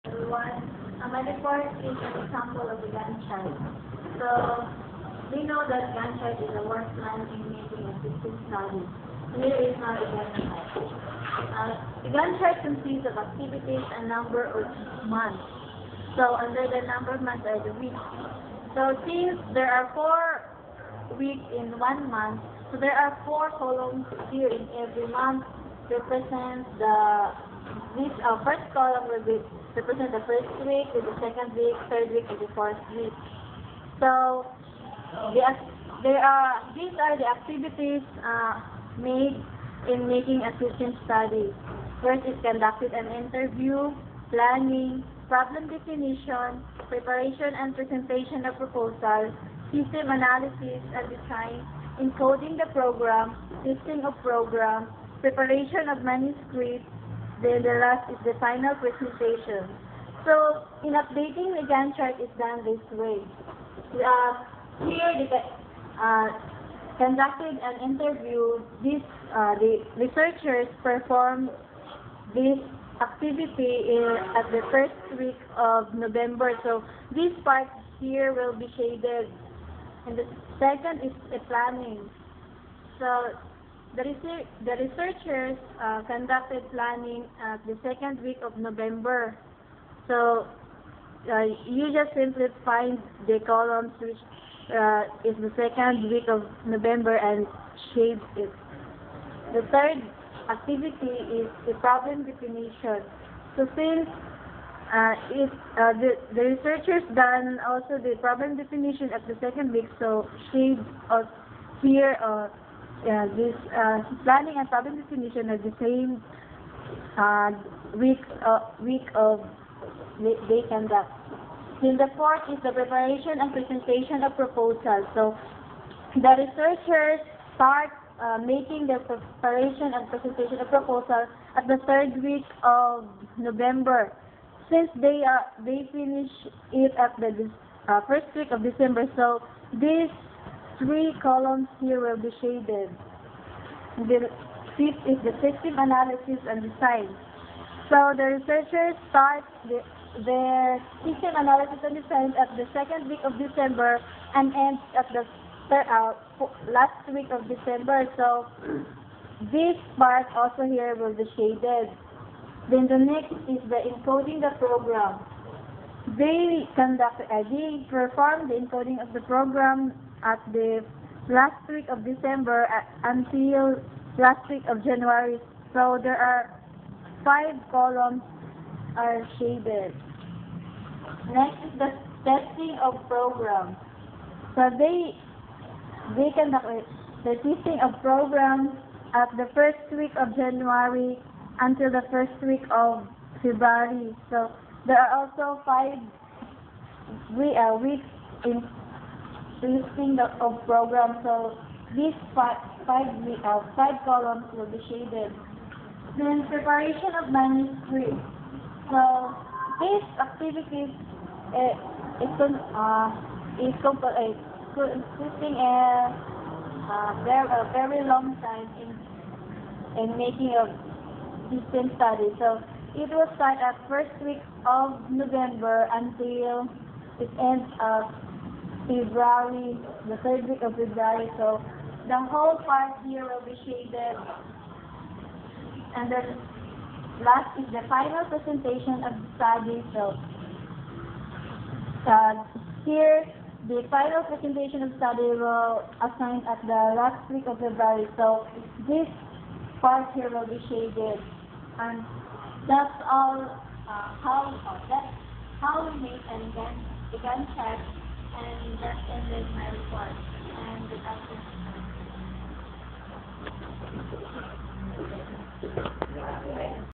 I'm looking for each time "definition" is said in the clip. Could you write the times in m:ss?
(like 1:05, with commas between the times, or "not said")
0:45, 1:42, 1:48, 1:55.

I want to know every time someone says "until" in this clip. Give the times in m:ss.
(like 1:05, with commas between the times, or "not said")
2:53, 3:11, 3:45.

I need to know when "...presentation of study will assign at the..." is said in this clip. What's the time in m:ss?
4:04.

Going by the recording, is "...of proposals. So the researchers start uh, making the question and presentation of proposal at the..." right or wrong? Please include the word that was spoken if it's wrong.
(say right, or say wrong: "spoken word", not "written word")
wrong: "preparation", not "question".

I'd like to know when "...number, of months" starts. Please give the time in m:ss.
0:14.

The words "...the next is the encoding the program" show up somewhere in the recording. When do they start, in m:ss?
2:42.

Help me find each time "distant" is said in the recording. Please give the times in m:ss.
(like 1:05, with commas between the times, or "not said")
0:08.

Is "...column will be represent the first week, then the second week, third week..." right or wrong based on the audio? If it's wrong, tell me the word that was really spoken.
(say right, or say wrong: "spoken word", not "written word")
right.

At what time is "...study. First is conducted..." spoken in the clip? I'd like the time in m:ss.
0:41.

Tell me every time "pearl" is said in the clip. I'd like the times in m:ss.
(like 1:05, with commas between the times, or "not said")
not said.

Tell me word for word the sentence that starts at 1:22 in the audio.
So, the, research, the researchers uh, conducted planning at the second week of November.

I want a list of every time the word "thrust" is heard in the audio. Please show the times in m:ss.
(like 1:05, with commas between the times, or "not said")
not said.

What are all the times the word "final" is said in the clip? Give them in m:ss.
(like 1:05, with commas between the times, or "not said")
0:58, 3:57, 4:03.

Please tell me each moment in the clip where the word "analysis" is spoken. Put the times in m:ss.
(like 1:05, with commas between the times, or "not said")
0:50, 2:25, 2:31.